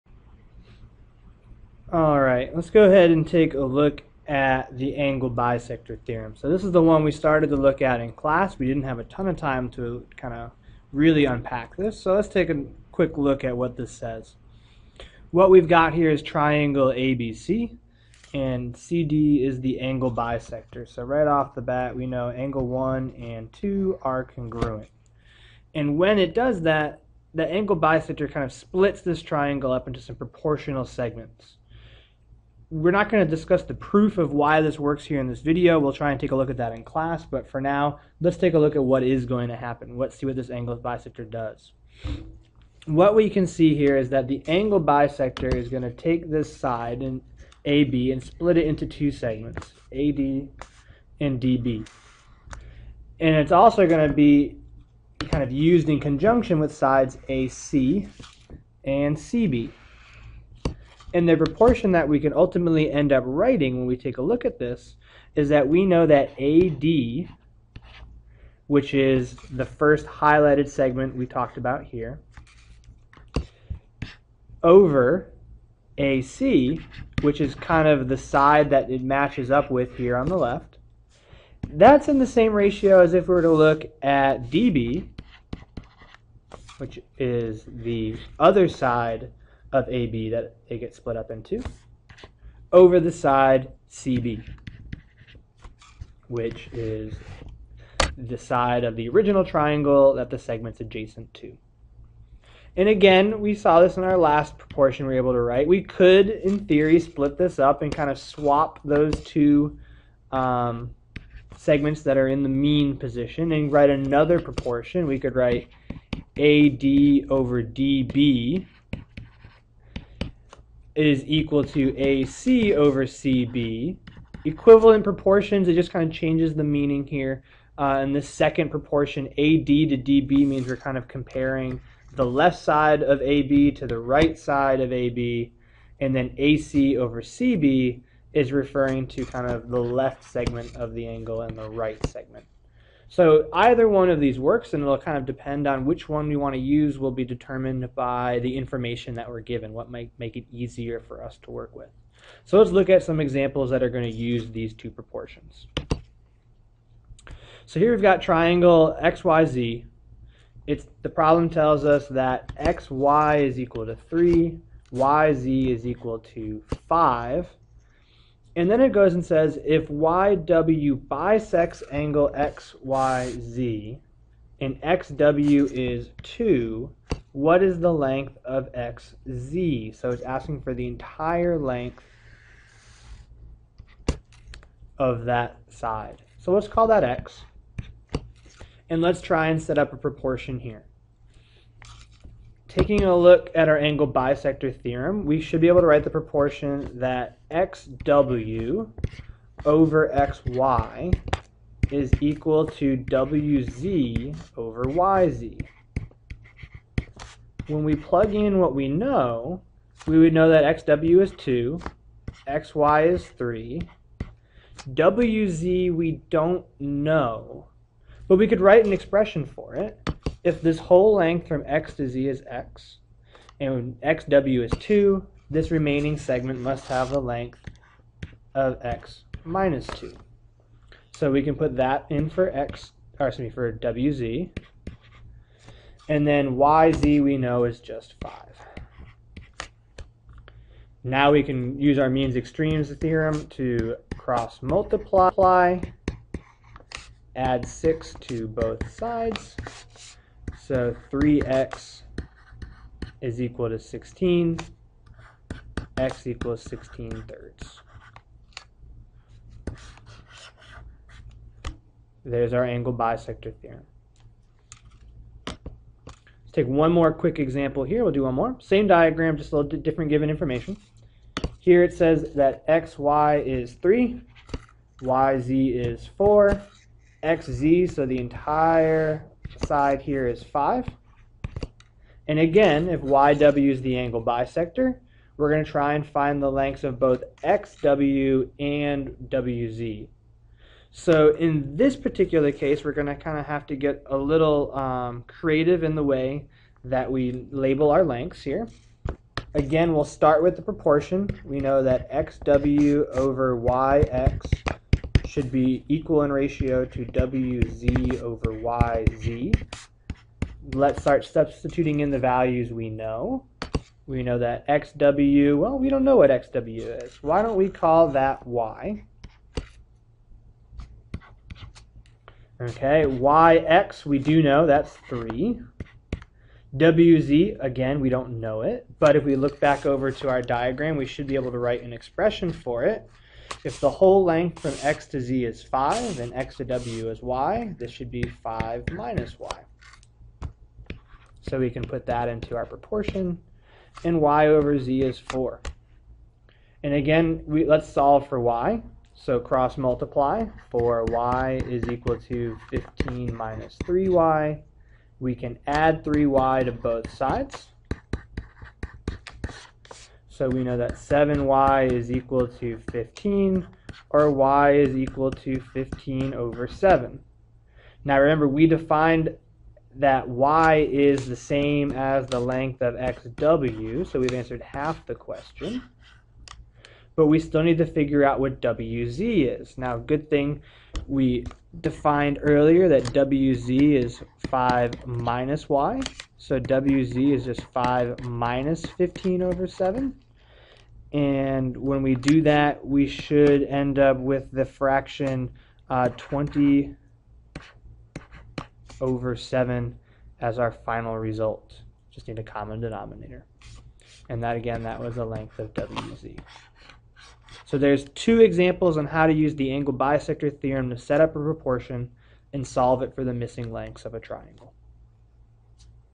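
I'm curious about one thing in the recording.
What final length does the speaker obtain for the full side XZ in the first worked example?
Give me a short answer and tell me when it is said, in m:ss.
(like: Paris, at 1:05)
16/3, at 4:16.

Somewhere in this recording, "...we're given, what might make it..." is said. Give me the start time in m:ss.
2:29.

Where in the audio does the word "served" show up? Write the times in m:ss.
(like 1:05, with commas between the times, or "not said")
not said.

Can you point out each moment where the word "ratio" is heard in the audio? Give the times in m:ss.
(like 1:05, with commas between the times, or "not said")
1:22, 5:06.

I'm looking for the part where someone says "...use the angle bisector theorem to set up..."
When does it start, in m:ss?
6:49.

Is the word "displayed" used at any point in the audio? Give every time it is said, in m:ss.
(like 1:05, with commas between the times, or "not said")
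not said.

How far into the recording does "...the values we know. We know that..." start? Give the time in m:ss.
5:12.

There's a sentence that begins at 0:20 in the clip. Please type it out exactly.
So right off the bat, we know angle 1 and 2 are congruent.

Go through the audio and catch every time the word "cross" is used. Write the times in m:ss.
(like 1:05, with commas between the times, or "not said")
4:04, 5:49.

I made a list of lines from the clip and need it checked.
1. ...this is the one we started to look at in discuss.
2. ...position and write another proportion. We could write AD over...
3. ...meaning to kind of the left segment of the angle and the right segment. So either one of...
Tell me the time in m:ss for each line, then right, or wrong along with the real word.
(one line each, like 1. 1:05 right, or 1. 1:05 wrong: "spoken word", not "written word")
1. 0:06 wrong: "class", not "discuss"
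2. 1:52 right
3. 2:18 wrong: "referring", not "meaning".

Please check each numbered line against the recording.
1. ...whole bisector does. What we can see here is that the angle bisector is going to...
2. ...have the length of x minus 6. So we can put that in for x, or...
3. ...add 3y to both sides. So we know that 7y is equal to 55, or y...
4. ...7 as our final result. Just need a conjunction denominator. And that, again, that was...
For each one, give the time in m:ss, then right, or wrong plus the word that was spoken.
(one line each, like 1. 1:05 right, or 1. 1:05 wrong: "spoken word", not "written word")
1. 0:40 wrong: "angle", not "whole"
2. 3:46 wrong: "2", not "6"
3. 5:55 wrong: "15", not "55"
4. 6:39 wrong: "common", not "conjunction".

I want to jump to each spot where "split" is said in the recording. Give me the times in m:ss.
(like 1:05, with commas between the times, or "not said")
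0:28, 0:48, 1:30, 1:47.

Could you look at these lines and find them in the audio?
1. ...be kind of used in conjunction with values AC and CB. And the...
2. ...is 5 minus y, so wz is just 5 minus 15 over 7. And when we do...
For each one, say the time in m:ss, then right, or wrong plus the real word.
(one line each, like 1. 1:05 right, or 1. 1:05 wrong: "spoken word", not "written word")
1. 0:54 wrong: "sides", not "values"
2. 6:24 right.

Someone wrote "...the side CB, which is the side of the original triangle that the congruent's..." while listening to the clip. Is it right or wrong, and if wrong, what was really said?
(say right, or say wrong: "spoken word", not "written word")
wrong: "segment", not "congruent".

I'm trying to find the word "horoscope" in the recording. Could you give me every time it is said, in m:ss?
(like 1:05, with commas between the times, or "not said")
not said.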